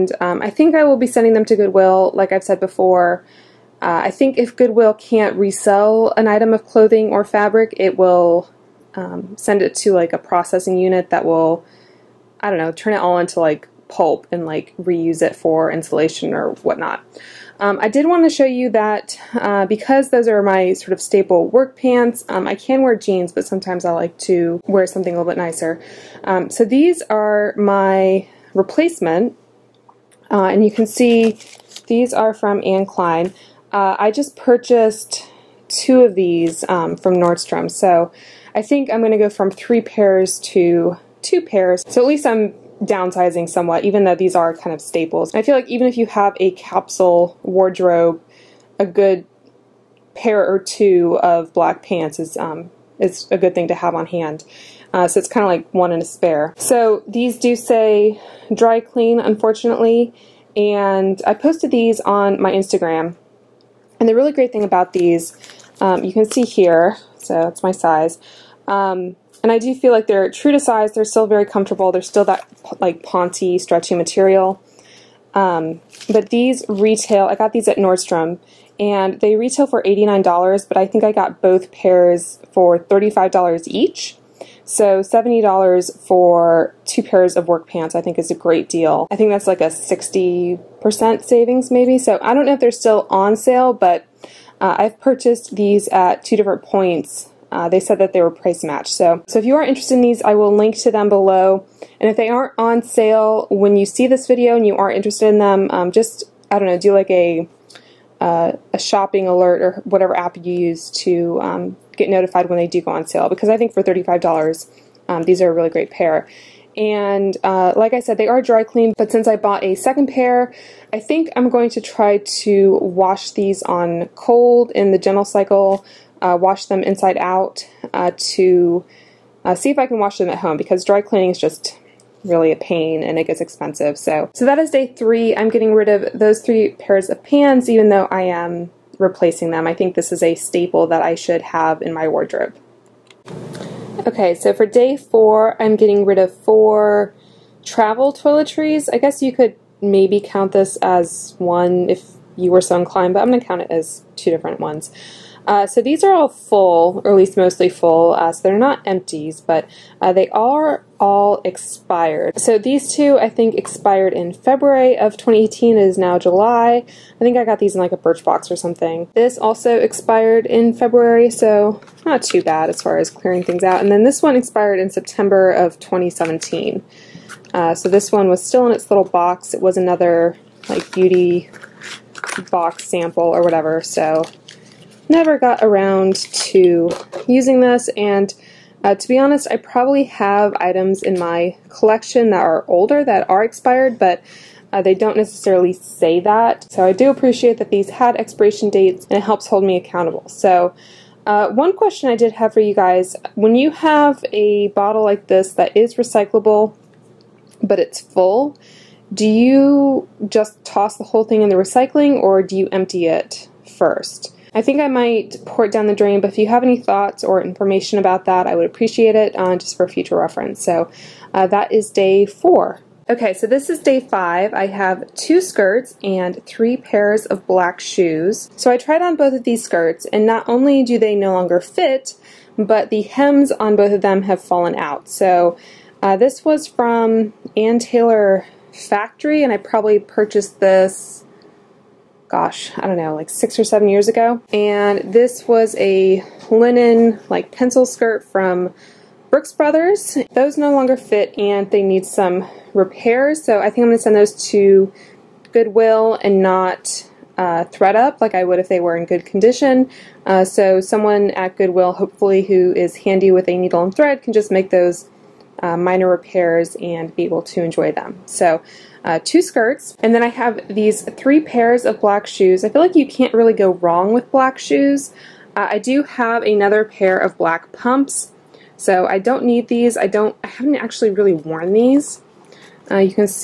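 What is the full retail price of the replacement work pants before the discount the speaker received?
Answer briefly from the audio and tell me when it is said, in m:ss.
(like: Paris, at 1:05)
$89, at 1:19.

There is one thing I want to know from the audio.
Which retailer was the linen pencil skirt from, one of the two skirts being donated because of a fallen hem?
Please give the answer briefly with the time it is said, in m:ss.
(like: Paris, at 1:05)
Brooks Brothers, at 4:09.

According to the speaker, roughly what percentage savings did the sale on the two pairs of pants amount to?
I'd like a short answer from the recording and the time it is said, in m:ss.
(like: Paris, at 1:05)
60%, at 1:29.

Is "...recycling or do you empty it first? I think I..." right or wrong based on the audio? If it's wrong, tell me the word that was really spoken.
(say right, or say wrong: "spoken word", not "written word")
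right.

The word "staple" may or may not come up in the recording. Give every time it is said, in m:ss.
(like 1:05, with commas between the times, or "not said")
0:21, 0:44, 2:20.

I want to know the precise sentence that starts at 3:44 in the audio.
I have two skirts and three pairs of black shoes.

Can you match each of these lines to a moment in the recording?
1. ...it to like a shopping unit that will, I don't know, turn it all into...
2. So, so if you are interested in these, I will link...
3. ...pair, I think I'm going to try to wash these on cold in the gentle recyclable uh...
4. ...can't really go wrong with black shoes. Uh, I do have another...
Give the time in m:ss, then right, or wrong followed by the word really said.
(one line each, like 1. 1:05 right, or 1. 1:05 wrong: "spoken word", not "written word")
1. 0:09 wrong: "processing", not "shopping"
2. 1:38 right
3. 2:00 wrong: "cycle", not "recyclable"
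4. 4:33 right.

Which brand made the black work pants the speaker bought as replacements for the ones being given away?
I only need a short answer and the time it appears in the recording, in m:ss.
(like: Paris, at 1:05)
Anne Klein, at 0:32.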